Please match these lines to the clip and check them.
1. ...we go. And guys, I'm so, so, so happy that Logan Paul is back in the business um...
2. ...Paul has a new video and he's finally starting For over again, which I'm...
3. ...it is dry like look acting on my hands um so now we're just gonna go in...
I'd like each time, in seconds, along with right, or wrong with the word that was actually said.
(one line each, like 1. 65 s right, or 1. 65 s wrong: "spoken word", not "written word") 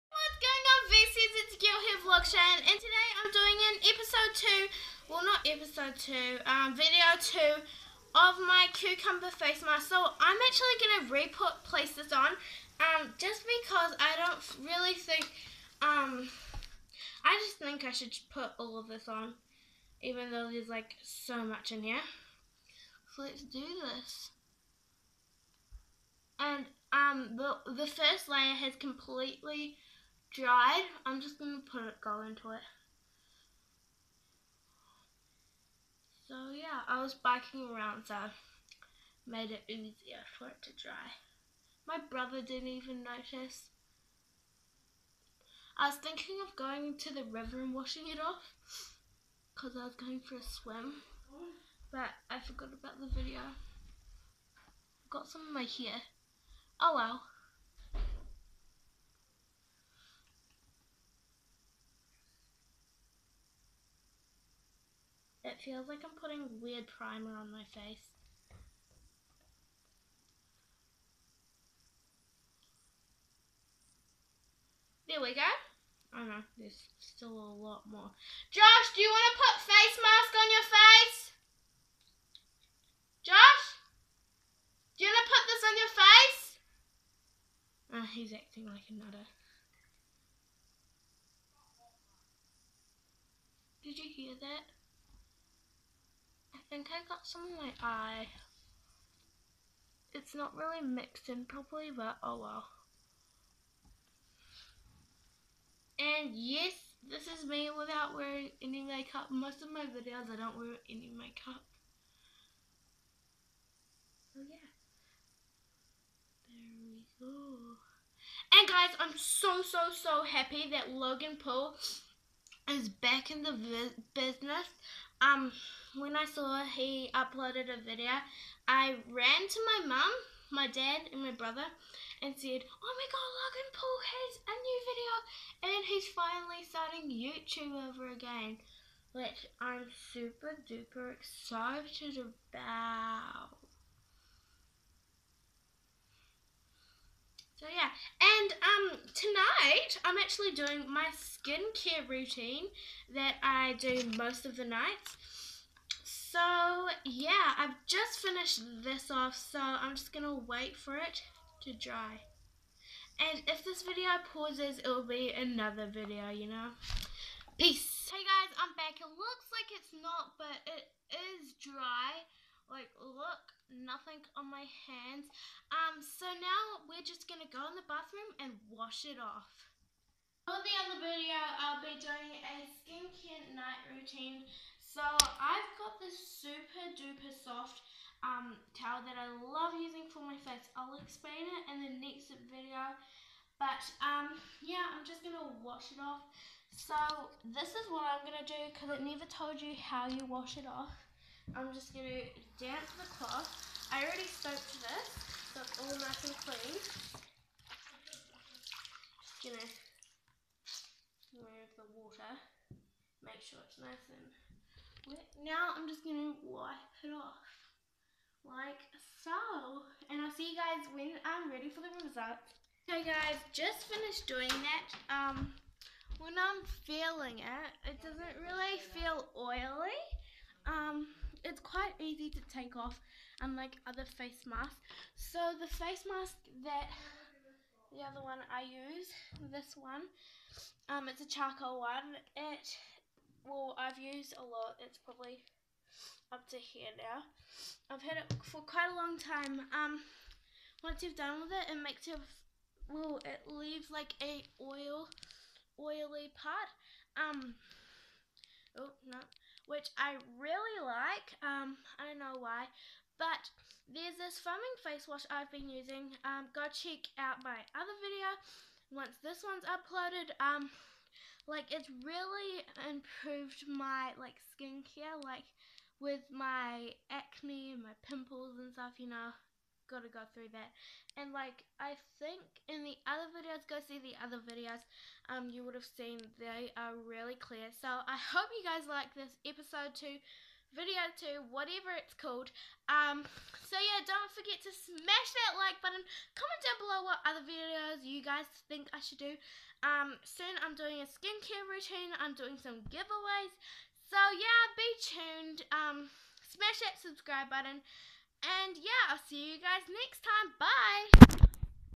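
1. 116 s right
2. 133 s wrong: "YouTube", not "For"
3. 170 s wrong: "nothing", not "acting".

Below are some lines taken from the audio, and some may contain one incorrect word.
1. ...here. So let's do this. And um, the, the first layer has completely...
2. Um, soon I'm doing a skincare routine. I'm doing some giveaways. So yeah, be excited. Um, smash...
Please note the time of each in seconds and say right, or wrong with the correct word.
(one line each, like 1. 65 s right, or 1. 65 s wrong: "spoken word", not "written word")
1. 21 s right
2. 299 s wrong: "tuned", not "excited".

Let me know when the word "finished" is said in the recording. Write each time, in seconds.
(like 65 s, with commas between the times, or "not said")
158 s, 223 s.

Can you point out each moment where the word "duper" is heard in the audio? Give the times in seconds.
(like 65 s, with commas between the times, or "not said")
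140 s, 186 s.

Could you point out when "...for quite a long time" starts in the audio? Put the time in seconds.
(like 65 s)
248 s.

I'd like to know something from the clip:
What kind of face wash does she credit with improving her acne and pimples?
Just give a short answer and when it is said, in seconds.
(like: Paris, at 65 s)
Foaming face wash, at 264 s.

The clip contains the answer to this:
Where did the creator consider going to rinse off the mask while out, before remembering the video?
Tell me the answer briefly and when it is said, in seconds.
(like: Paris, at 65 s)
The river, at 47 s.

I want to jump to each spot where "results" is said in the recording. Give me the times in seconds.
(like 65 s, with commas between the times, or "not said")
221 s.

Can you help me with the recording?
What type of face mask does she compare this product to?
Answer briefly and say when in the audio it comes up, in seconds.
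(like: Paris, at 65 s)
Charcoal, at 241 s.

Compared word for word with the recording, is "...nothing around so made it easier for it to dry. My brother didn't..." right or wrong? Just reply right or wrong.
wrong.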